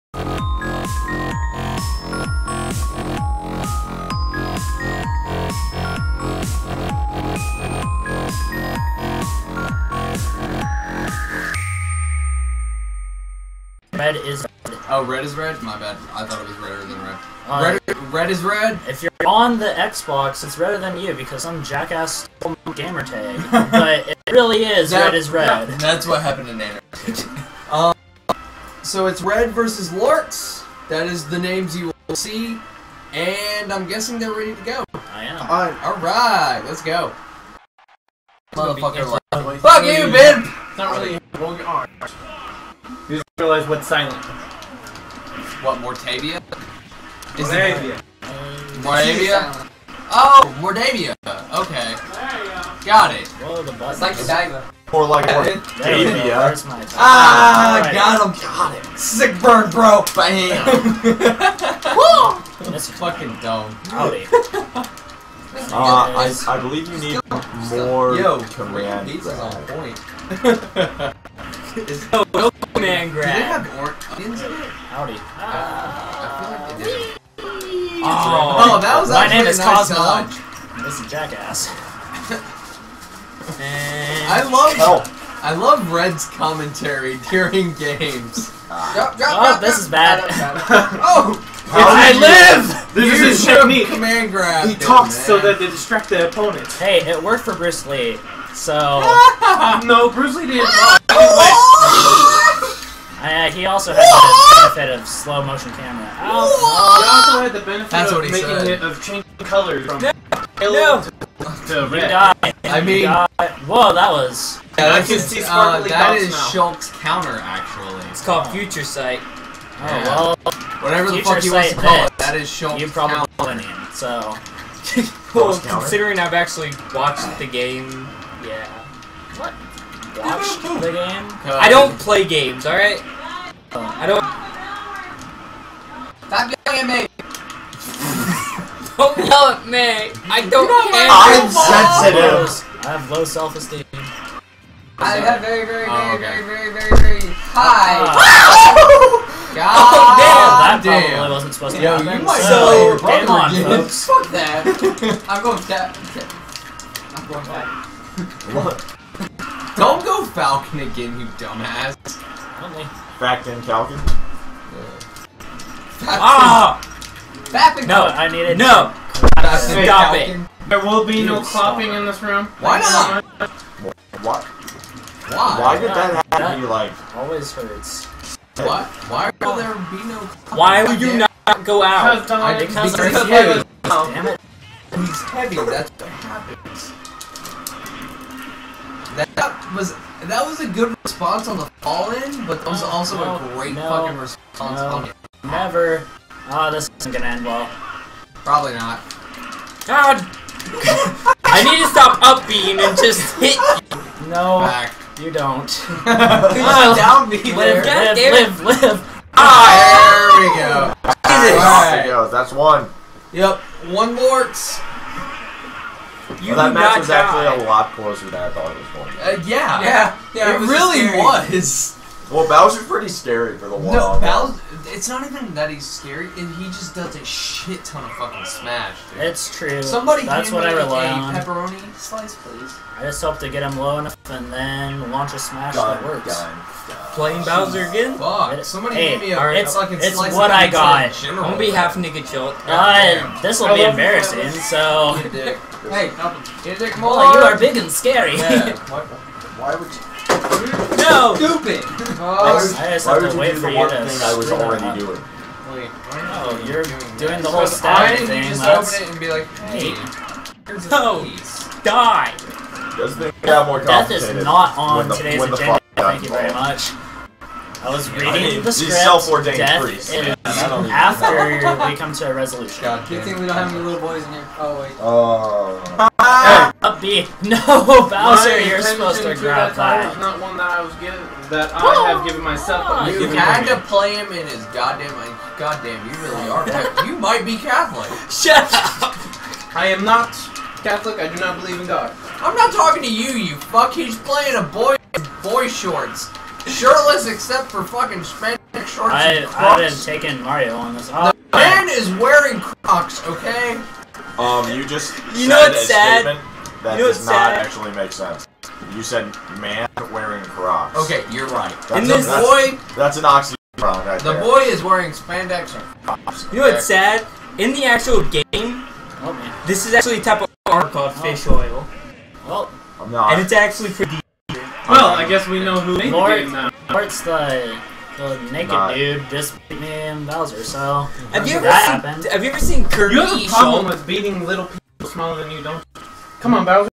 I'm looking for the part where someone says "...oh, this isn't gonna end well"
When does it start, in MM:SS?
03:16.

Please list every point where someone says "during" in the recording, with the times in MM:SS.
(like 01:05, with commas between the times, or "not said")
01:27.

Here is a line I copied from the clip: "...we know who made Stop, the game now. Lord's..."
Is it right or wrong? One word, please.
wrong.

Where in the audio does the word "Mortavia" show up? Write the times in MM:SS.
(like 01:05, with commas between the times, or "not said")
00:45.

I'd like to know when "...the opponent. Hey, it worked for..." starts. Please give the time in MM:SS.
01:36.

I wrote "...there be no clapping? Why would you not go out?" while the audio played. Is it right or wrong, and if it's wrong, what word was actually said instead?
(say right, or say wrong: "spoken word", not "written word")
right.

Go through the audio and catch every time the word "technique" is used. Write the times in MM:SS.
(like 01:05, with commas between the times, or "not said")
01:33.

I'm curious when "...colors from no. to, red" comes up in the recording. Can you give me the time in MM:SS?
01:49.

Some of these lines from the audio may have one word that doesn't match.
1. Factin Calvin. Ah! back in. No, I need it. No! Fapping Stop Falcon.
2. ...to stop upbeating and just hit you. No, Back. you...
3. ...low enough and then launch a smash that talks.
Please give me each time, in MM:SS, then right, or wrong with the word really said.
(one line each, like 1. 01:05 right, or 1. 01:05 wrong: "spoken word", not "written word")
1. 02:43 right
2. 03:21 right
3. 03:53 wrong: "works", not "talks".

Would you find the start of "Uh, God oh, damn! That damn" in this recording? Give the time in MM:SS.
02:28.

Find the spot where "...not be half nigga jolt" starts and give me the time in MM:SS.
04:01.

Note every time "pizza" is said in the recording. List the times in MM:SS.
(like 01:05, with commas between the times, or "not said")
01:09.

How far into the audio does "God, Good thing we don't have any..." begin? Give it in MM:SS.
04:32.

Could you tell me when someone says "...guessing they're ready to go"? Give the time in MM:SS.
00:33.